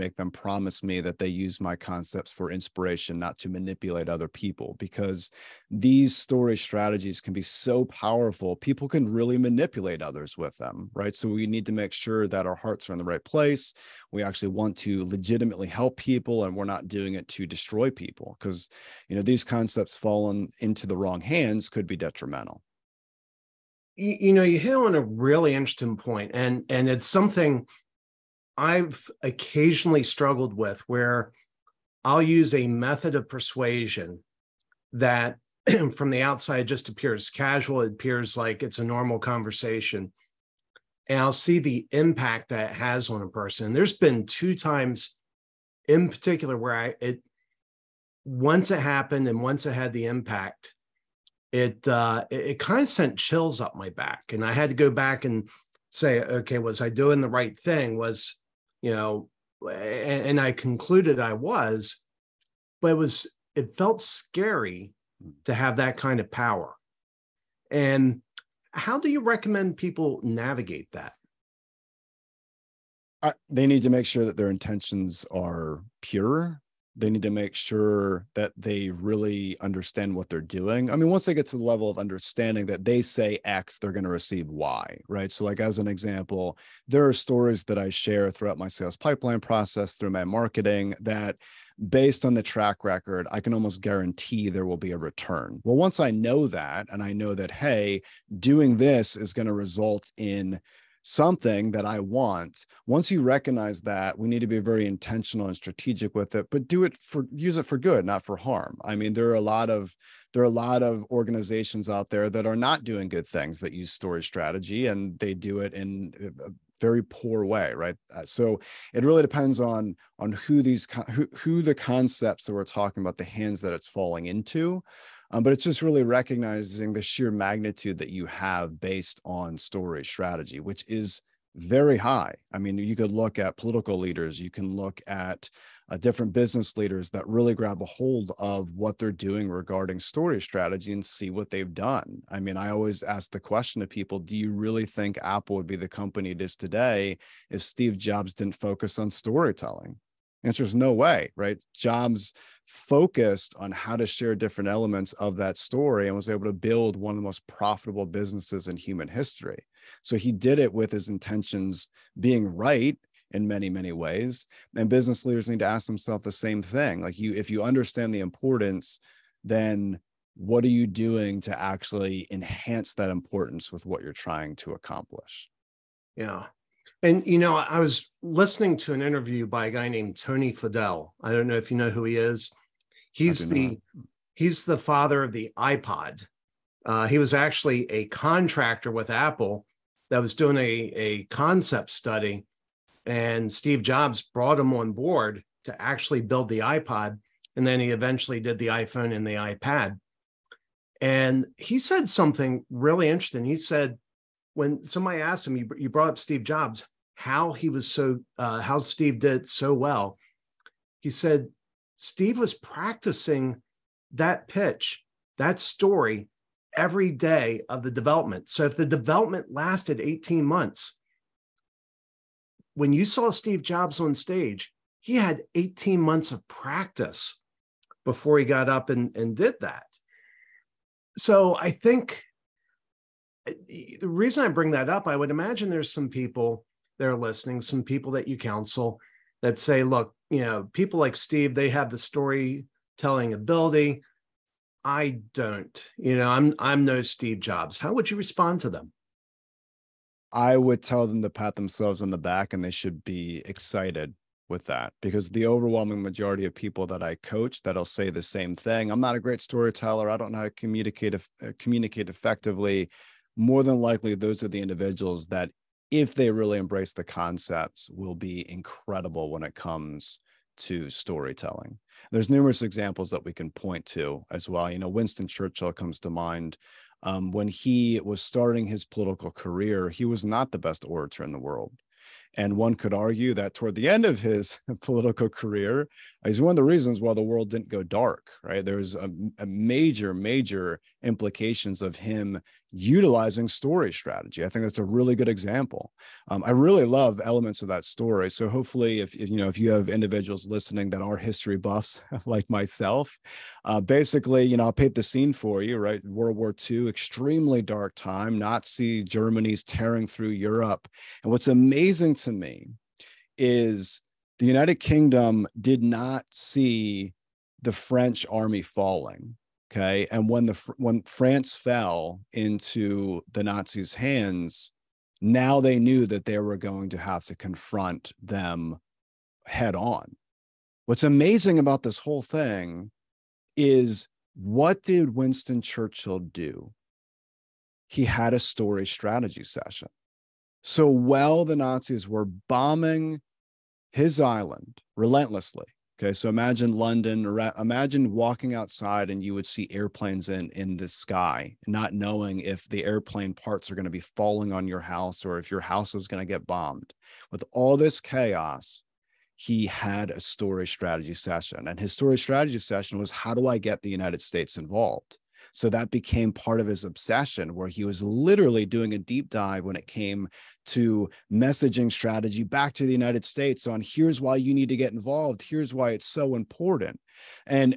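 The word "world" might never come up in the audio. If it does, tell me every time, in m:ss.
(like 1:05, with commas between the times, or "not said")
4:41, 4:47, 5:06.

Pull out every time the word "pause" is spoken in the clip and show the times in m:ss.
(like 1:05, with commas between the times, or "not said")
not said.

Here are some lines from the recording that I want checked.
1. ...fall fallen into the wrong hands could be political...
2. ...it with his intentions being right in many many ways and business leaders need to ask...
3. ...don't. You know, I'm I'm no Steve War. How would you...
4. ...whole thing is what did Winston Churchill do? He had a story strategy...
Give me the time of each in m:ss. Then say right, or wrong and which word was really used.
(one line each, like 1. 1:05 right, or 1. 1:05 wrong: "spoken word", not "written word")
1. 0:19 wrong: "detrimental", not "political"
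2. 2:40 right
3. 4:05 wrong: "Jobs", not "War"
4. 5:31 right.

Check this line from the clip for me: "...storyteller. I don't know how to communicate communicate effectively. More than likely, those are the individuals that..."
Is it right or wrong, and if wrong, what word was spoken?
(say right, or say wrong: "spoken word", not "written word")
right.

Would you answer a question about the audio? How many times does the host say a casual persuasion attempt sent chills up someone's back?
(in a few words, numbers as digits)
2.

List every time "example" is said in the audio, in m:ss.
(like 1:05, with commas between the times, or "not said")
1:25, 4:32, 4:55.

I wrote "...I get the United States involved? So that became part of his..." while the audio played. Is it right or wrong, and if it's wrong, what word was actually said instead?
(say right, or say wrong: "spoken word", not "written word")
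right.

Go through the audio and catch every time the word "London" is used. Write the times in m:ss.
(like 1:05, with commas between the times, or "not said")
5:46.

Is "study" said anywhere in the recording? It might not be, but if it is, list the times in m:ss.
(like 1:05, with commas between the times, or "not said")
3:11.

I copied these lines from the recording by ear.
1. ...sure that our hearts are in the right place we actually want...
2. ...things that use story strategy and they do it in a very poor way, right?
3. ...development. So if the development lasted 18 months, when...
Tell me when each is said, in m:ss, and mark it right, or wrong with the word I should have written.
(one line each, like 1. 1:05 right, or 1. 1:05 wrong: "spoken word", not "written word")
1. 0:11 right
2. 1:53 right
3. 3:37 right.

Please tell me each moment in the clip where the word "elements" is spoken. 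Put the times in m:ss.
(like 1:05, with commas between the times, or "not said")
2:34, 4:57.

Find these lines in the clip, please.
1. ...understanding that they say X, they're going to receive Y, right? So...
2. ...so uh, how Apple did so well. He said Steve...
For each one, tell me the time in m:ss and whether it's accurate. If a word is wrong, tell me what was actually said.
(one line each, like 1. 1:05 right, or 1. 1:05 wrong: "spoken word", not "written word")
1. 1:21 right
2. 3:27 wrong: "Steve", not "Apple".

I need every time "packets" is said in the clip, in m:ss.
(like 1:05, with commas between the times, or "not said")
not said.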